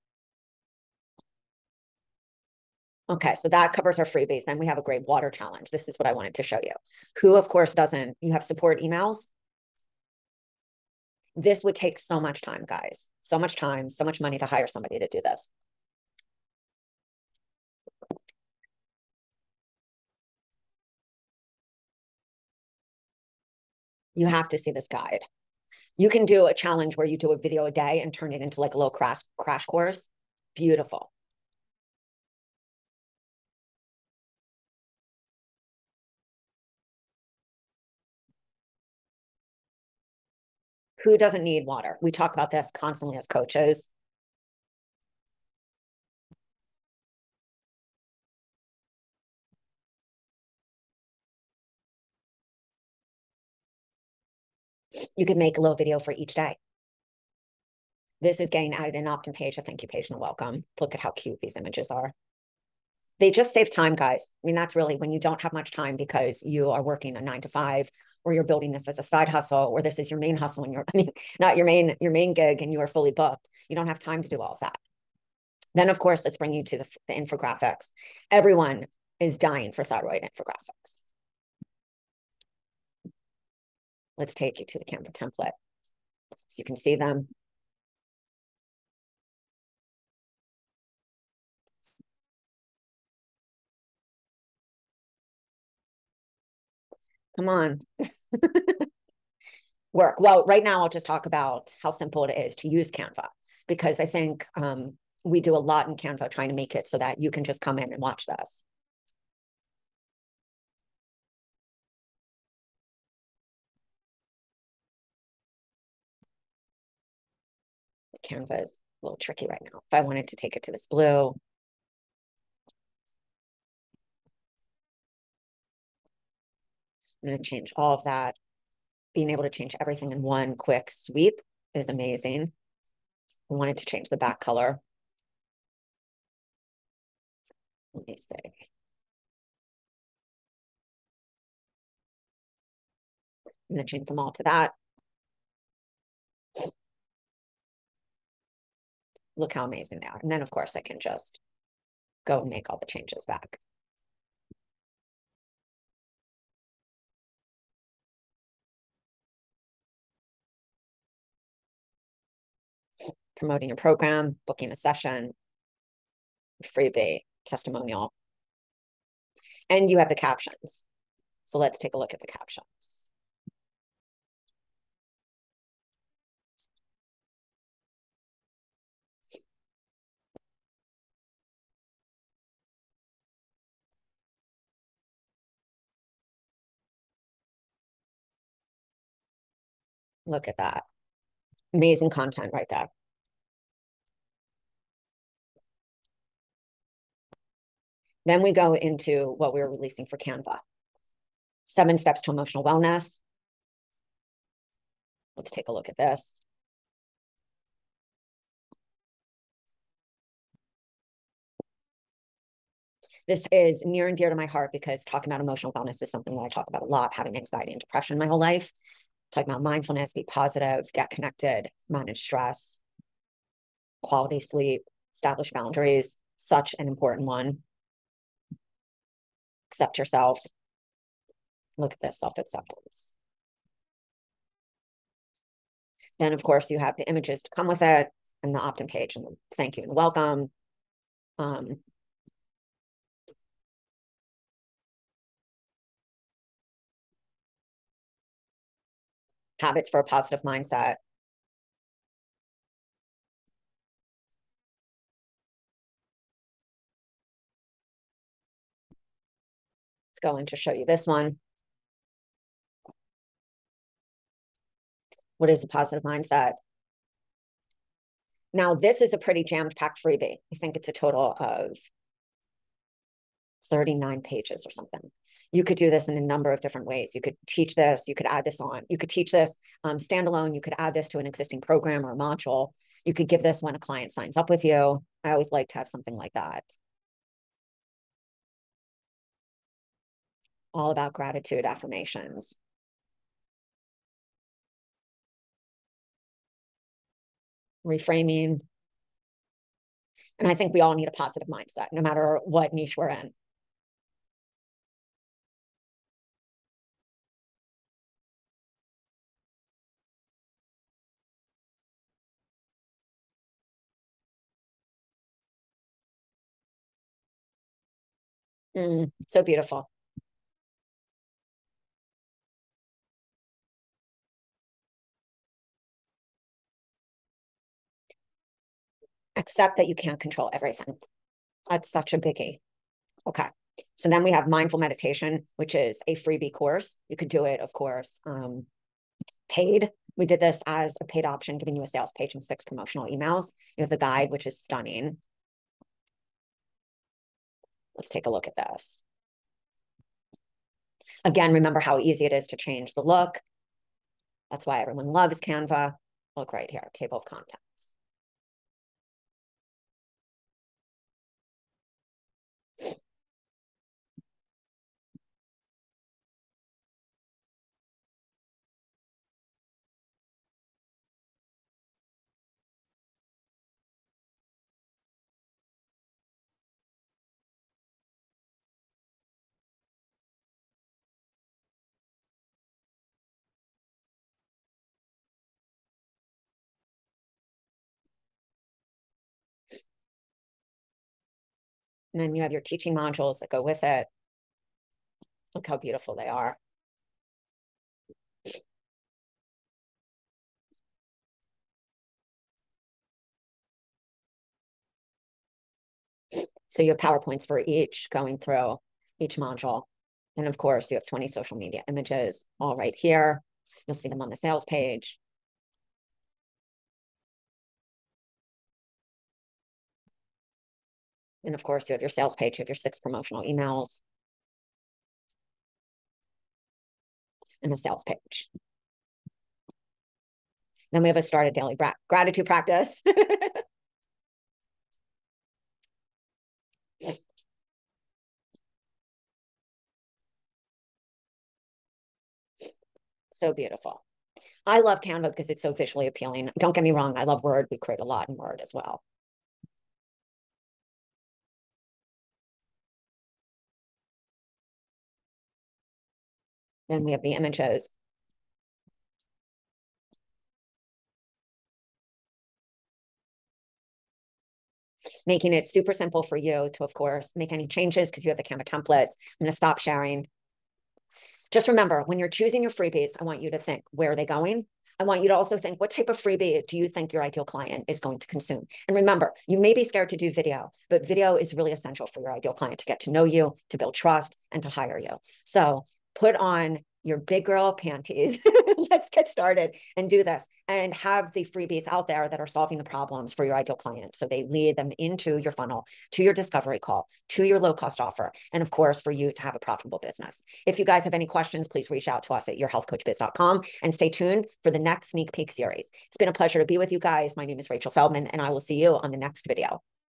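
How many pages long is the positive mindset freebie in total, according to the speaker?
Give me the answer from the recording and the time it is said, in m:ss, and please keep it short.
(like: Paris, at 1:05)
39, at 4:33.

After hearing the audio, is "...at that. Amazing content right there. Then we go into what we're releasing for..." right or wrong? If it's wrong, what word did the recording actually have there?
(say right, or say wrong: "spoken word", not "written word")
right.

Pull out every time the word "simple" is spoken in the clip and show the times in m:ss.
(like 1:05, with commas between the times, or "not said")
1:41, 7:45.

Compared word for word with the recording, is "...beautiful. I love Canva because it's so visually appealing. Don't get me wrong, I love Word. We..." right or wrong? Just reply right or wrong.
right.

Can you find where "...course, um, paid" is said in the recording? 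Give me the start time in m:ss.
5:37.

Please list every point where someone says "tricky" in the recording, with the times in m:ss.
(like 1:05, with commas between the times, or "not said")
1:59.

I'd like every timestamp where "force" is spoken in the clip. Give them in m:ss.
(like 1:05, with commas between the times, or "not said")
not said.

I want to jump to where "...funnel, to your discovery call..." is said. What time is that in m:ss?
8:15.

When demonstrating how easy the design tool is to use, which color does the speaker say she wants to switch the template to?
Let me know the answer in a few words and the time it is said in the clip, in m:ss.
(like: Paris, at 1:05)
Blue, at 2:00.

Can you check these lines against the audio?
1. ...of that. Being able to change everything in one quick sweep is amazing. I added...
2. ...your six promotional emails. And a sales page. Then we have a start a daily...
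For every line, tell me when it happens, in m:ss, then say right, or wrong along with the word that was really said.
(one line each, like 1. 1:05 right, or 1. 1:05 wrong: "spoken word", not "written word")
1. 2:07 wrong: "wanted", not "added"
2. 7:02 right.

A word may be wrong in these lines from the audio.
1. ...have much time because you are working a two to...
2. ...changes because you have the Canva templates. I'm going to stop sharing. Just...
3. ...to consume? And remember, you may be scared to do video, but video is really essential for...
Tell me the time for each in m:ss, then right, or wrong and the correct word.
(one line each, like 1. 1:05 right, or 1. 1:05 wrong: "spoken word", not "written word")
1. 1:05 wrong: "nine", not "two"
2. 7:47 right
3. 7:58 right.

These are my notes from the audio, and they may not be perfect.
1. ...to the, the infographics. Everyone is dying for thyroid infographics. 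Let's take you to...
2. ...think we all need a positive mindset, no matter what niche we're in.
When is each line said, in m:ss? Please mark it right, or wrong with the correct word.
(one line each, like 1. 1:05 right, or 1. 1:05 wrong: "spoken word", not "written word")
1. 1:16 right
2. 5:00 right.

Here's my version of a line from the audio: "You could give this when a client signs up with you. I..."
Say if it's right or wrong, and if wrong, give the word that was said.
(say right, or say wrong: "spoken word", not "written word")
right.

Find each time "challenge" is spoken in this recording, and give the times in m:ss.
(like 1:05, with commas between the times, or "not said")
0:05, 0:26.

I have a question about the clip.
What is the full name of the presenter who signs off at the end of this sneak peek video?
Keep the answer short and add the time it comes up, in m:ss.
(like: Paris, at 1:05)
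Rachel Feldman, at 8:27.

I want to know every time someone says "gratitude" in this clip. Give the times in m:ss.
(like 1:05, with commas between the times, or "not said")
4:51, 7:12.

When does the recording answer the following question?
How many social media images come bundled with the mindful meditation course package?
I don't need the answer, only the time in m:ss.
6:51.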